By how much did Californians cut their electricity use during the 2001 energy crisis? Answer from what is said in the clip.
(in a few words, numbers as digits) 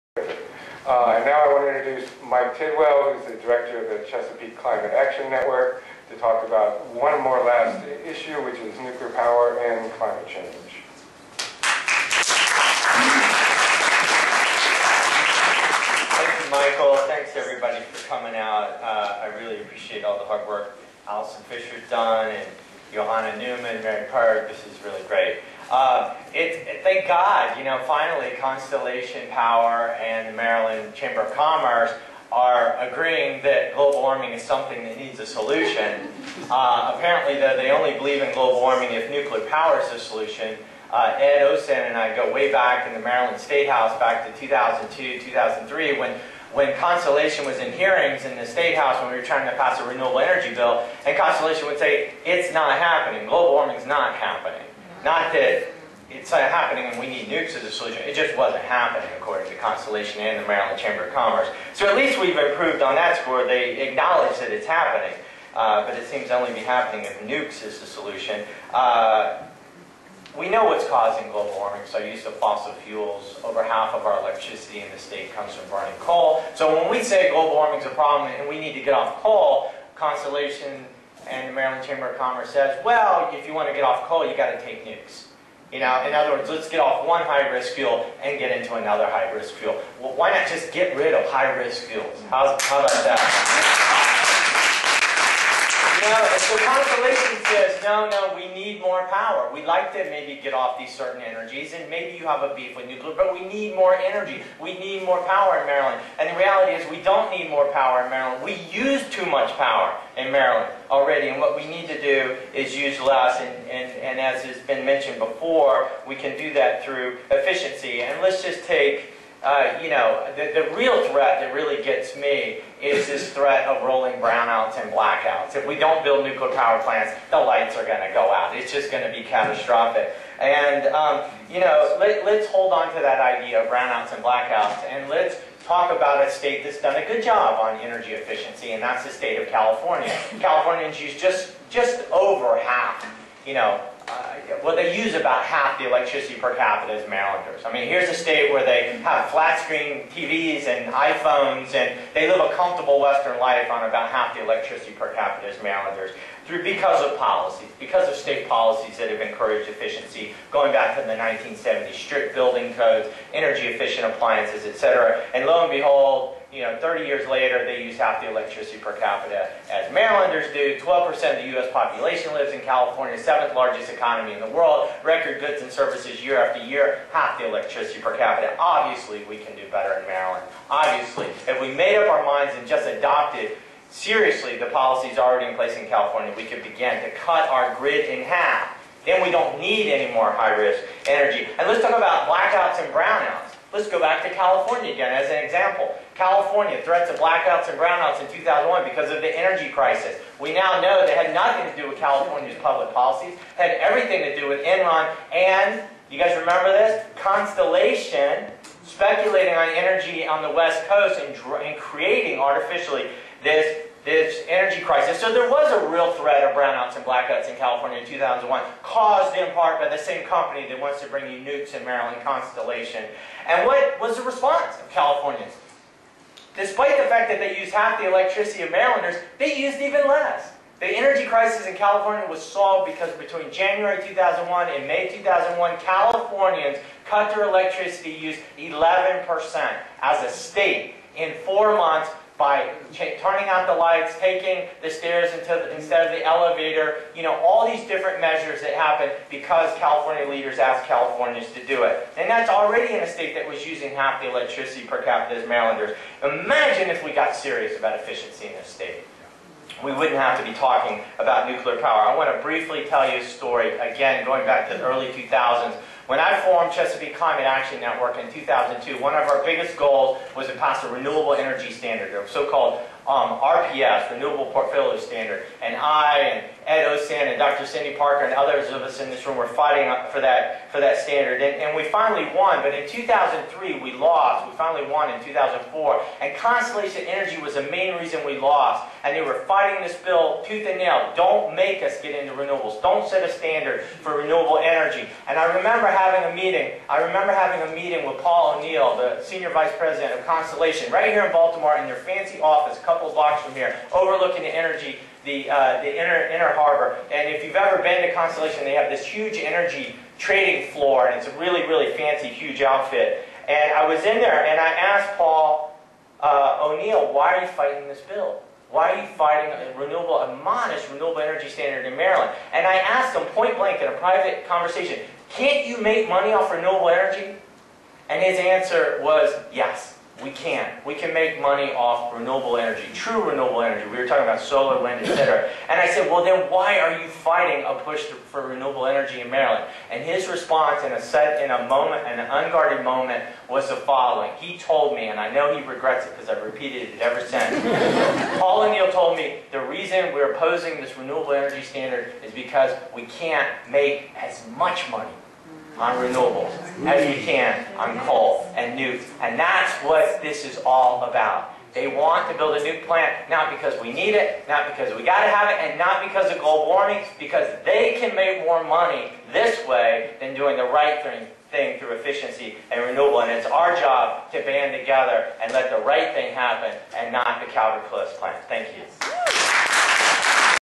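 11%.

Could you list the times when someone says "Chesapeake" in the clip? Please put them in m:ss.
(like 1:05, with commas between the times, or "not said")
0:04, 4:26.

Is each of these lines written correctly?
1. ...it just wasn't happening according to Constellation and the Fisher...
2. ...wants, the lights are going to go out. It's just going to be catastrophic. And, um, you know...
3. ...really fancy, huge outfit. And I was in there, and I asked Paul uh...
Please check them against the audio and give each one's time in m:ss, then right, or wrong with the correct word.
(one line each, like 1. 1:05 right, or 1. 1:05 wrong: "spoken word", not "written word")
1. 0:58 wrong: "Maryland", not "Fisher"
2. 2:06 wrong: "plants", not "wants"
3. 5:11 right.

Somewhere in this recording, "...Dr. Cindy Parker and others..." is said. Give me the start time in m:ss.
4:37.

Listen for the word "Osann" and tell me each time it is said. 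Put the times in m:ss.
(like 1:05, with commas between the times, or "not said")
0:41, 4:36.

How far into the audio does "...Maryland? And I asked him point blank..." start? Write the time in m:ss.
5:21.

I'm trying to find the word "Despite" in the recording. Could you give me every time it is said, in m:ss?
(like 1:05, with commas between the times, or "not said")
3:46.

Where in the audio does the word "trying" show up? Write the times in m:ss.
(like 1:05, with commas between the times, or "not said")
0:49.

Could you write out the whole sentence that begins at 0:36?
Uh, apparently, though, they only believe in global warming if nuclear power is the solution.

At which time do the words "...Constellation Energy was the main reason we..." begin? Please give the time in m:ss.
4:46.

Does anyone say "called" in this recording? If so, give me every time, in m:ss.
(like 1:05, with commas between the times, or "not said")
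4:32.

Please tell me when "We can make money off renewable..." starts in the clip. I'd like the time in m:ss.
5:30.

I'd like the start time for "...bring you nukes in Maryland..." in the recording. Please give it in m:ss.
3:41.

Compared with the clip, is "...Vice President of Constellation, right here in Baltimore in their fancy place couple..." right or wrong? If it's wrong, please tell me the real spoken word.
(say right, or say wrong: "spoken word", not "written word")
wrong: "office", not "place".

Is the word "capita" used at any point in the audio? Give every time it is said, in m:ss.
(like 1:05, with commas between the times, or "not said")
2:26, 2:35, 2:48, 2:58, 4:15.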